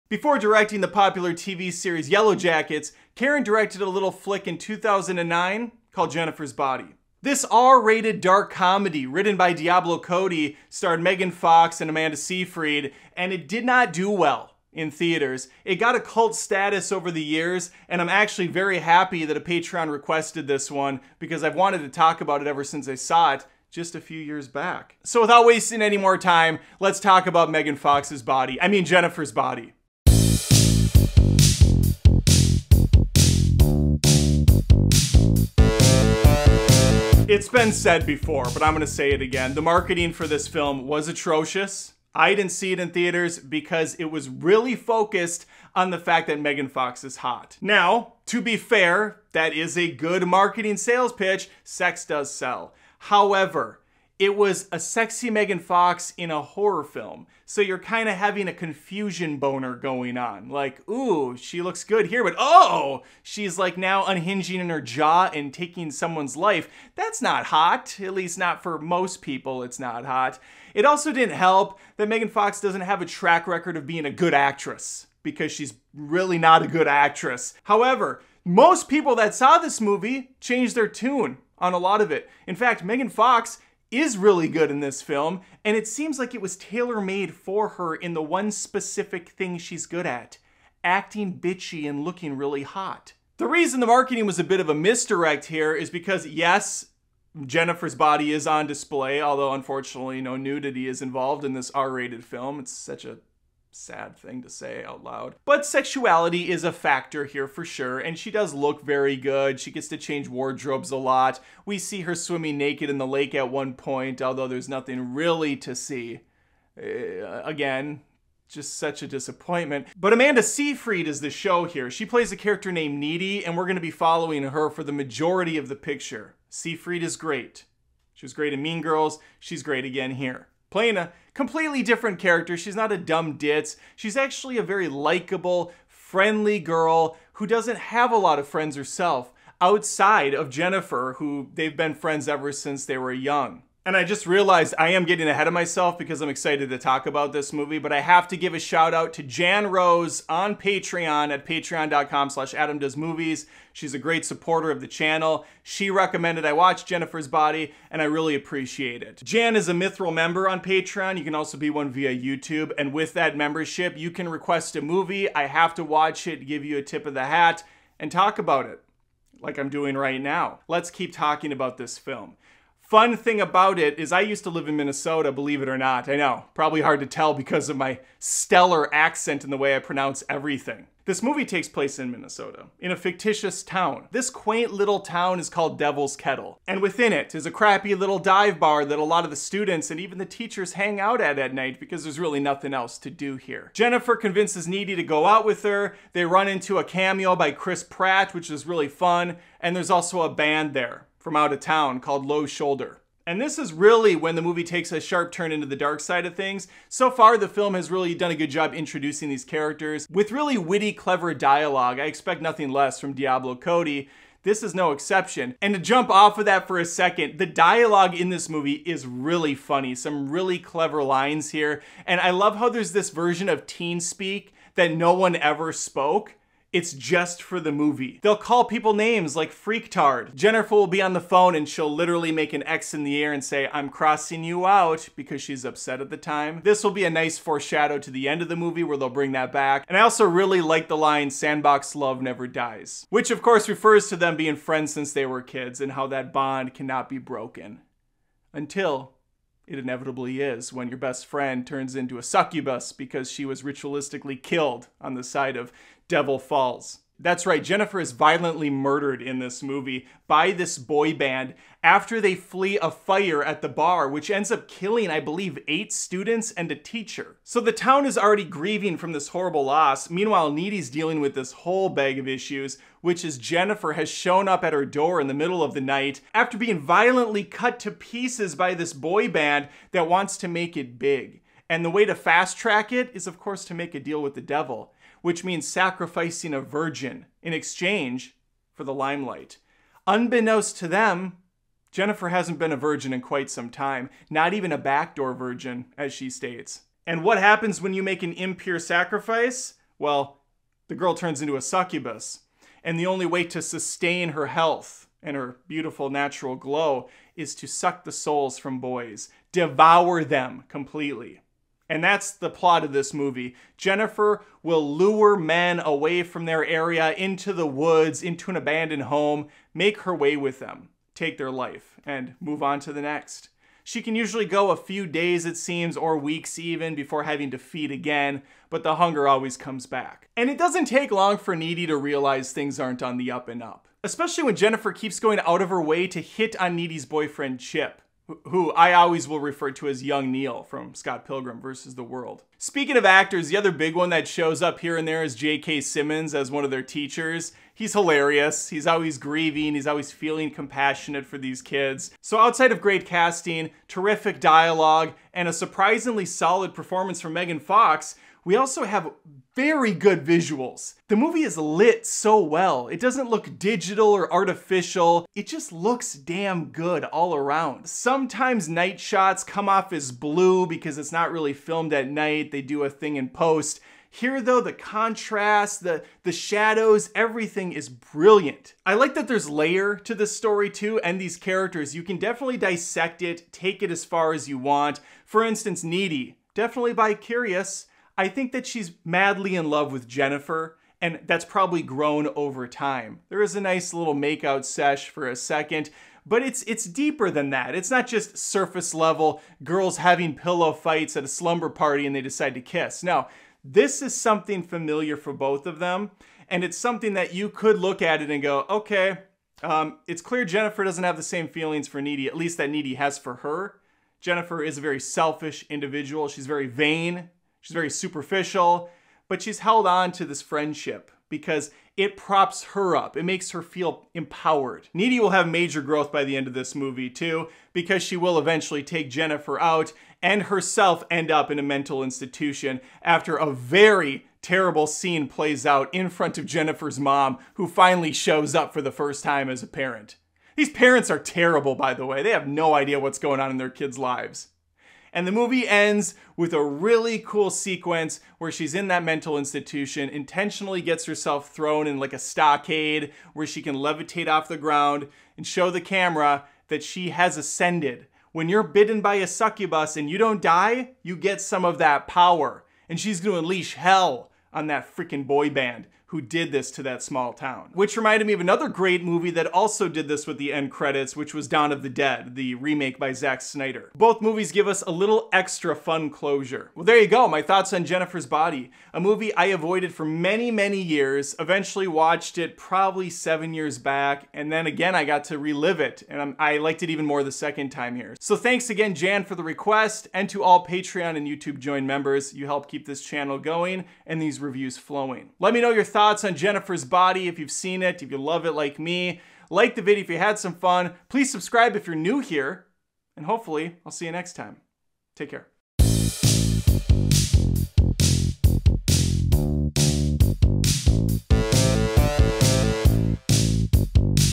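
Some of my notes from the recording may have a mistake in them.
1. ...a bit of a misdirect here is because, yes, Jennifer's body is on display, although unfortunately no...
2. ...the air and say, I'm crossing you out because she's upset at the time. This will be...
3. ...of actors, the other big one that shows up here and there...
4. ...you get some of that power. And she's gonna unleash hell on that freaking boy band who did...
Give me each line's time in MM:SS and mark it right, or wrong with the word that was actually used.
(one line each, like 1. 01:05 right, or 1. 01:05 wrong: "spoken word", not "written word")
1. 01:34 right
2. 03:53 right
3. 05:42 right
4. 07:41 right.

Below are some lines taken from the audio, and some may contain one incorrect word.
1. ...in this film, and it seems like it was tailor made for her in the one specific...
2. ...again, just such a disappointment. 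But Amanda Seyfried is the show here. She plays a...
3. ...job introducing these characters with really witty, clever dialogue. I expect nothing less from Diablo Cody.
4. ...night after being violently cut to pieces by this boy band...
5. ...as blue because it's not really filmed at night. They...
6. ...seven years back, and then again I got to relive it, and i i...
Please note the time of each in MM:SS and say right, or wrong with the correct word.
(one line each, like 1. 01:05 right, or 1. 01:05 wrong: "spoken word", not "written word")
1. 01:24 right
2. 01:57 right
3. 03:28 right
4. 04:35 right
5. 06:09 right
6. 08:03 right.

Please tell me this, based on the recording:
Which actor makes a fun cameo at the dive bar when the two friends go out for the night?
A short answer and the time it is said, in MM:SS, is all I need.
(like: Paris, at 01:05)
Chris Pratt, at 03:17.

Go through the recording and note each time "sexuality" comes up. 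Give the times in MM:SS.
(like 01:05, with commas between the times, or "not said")
01:45.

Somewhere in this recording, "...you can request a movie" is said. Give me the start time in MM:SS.
02:43.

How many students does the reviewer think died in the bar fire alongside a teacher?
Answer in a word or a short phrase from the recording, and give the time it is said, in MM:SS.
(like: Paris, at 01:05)
8, at 04:25.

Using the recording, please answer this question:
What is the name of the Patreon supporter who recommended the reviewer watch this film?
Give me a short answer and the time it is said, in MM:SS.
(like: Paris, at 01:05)
Jan Rose, at 02:29.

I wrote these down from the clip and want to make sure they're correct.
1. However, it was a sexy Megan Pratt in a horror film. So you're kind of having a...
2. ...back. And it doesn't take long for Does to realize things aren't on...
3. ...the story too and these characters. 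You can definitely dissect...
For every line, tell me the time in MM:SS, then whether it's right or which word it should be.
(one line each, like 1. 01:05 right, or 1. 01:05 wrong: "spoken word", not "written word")
1. 00:52 wrong: "Fox", not "Pratt"
2. 05:29 wrong: "Needy", not "Does"
3. 06:20 right.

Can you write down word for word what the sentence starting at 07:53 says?
Both movies give us a little extra fun closure.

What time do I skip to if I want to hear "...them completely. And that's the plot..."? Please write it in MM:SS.
05:10.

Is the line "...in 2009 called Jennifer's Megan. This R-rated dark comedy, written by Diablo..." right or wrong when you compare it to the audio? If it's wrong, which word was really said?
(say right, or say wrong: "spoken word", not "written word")
wrong: "Body", not "Megan".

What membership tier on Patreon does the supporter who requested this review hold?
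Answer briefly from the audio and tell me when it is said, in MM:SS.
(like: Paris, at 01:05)
Mithril, at 02:39.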